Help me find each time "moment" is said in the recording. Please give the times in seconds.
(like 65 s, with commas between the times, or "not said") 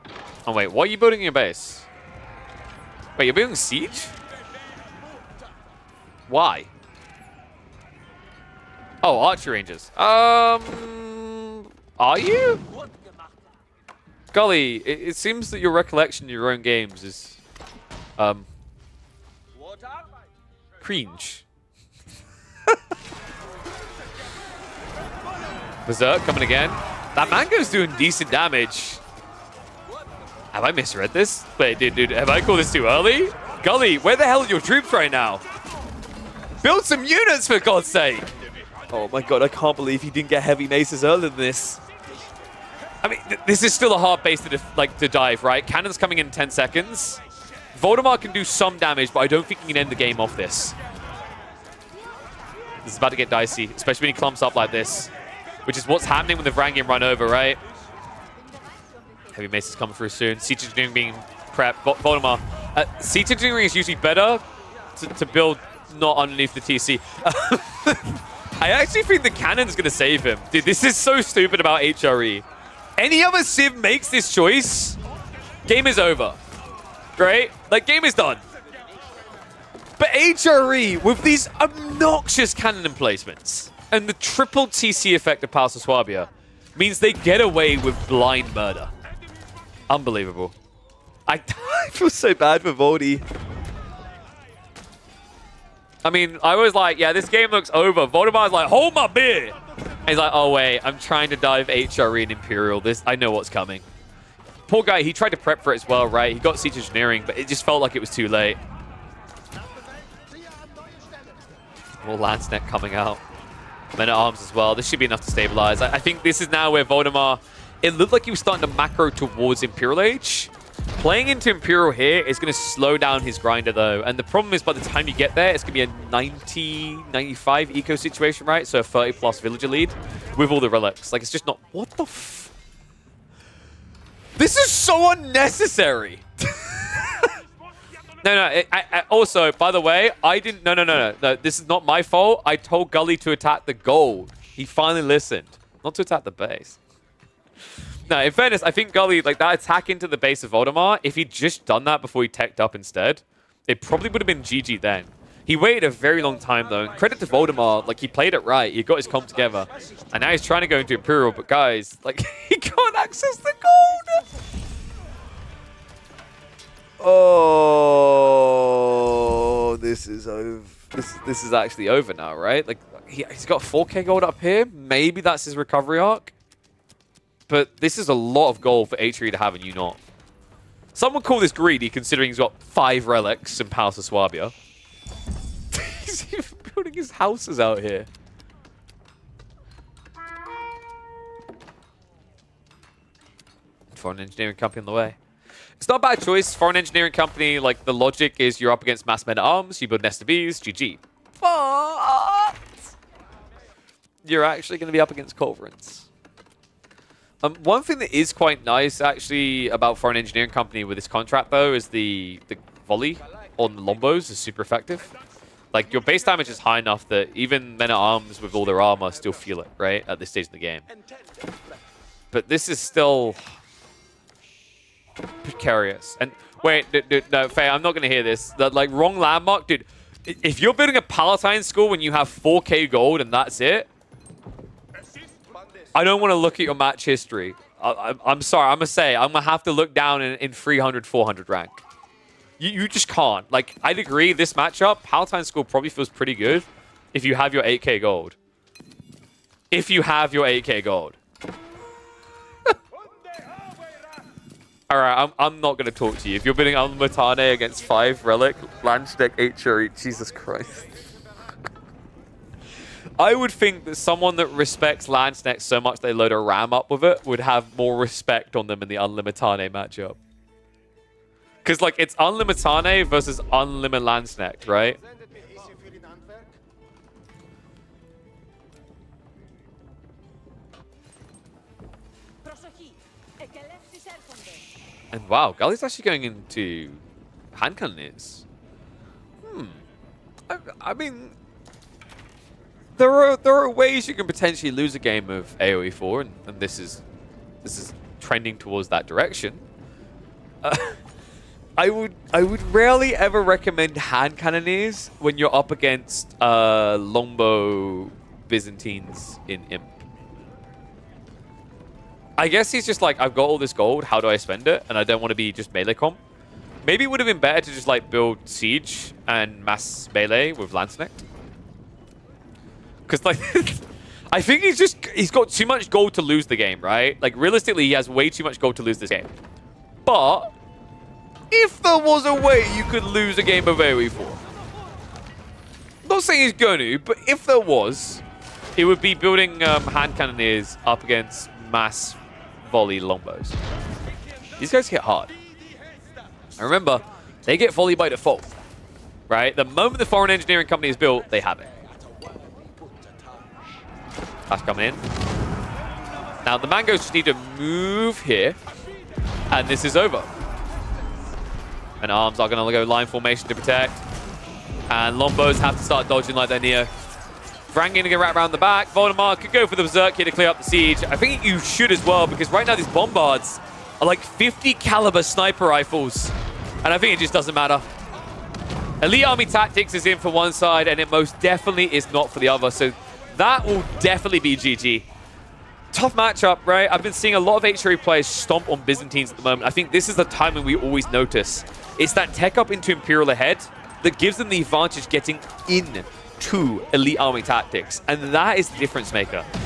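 349 s, 389 s.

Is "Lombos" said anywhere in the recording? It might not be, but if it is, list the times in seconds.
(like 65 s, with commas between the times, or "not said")
213 s, 365 s.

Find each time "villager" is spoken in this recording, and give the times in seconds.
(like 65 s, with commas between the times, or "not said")
129 s.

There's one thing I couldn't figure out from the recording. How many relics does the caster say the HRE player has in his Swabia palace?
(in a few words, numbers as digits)
5.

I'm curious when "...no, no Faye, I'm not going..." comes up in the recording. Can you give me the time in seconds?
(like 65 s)
227 s.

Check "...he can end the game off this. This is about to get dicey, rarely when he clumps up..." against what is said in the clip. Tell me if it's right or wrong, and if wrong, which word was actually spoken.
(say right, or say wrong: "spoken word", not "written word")
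wrong: "especially", not "rarely".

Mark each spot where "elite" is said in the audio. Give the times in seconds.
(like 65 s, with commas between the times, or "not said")
379 s, 396 s.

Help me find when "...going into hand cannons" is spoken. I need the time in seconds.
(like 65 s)
286 s.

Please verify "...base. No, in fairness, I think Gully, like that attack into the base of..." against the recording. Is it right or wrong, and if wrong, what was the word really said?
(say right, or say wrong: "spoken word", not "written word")
right.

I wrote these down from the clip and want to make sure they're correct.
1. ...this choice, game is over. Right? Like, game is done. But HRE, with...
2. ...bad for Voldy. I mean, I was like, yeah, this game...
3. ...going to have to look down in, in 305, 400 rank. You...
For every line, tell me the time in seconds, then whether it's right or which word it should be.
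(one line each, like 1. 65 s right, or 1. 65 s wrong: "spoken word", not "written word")
1. 74 s right
2. 92 s right
3. 239 s wrong: "300", not "305".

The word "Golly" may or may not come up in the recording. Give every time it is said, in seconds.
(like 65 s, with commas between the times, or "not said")
14 s.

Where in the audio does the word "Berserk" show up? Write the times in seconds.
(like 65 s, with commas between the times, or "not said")
25 s, 369 s.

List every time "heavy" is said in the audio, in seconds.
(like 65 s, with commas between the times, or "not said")
40 s, 59 s.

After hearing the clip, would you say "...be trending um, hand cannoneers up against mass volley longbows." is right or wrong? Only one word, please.
wrong.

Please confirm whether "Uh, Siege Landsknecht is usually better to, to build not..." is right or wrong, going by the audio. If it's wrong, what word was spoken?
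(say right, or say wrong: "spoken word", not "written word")
wrong: "Engineering", not "Landsknecht".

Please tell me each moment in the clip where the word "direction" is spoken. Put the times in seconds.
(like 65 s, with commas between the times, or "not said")
299 s.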